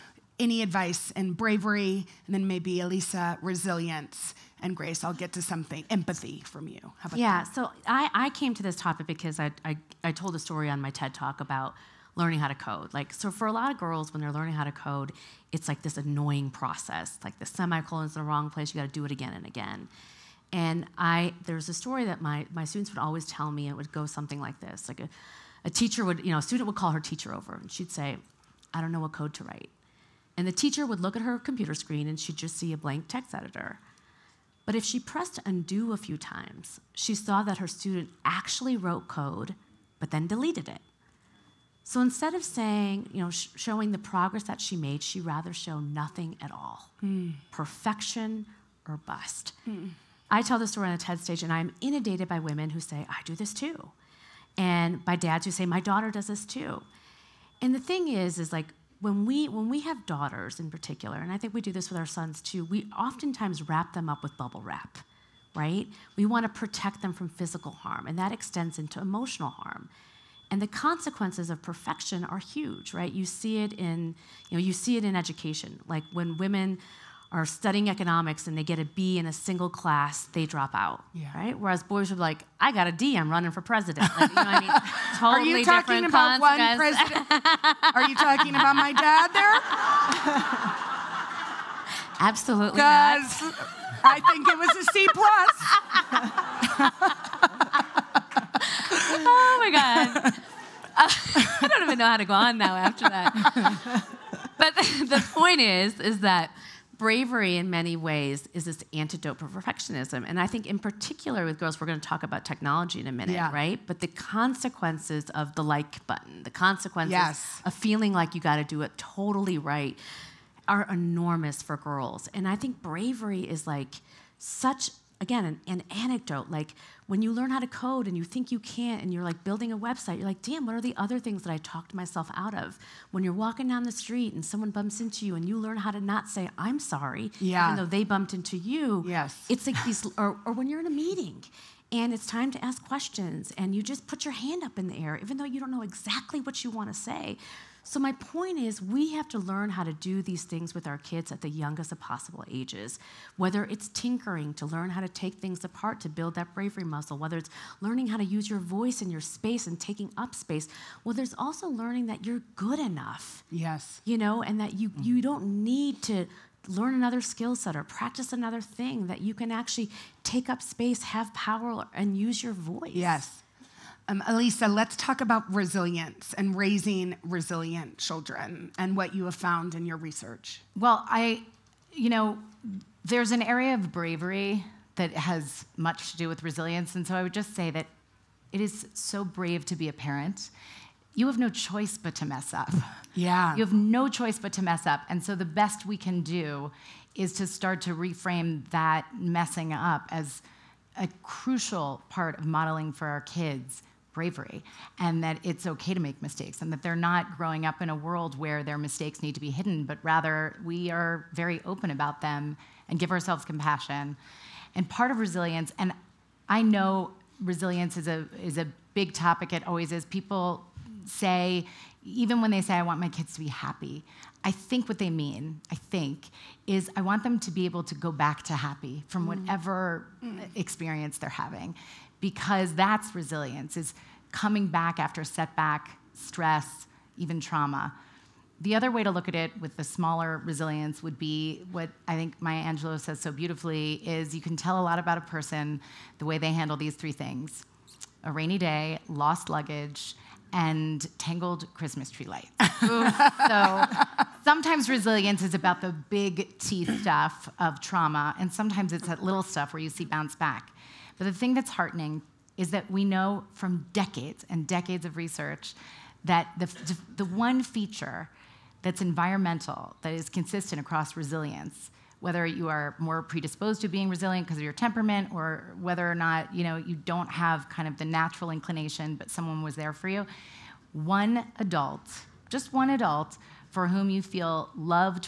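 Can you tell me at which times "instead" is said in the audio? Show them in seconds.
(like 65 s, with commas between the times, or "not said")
42 s.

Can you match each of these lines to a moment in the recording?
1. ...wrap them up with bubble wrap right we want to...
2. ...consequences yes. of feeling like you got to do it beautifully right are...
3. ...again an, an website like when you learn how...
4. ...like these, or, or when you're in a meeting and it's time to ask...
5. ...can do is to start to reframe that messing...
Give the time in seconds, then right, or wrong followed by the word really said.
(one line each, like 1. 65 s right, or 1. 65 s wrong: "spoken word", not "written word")
1. 63 s right
2. 116 s wrong: "totally", not "beautifully"
3. 125 s wrong: "anecdote", not "website"
4. 139 s right
5. 195 s right.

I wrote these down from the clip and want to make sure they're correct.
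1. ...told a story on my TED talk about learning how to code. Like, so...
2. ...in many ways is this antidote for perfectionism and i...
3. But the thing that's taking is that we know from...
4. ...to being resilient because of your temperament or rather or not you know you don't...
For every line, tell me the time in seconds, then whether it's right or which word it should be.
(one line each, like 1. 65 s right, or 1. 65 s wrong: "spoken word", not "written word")
1. 10 s right
2. 107 s right
3. 261 s wrong: "heartening", not "taking"
4. 273 s wrong: "whether", not "rather".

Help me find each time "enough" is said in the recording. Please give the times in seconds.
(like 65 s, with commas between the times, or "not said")
162 s.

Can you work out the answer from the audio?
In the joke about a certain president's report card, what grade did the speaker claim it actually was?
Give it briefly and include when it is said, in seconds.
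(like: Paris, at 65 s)
C plus, at 94 s.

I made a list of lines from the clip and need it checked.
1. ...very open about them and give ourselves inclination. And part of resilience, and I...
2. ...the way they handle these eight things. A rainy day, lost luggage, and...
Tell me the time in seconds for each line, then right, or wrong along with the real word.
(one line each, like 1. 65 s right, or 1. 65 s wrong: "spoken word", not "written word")
1. 211 s wrong: "compassion", not "inclination"
2. 246 s wrong: "three", not "eight".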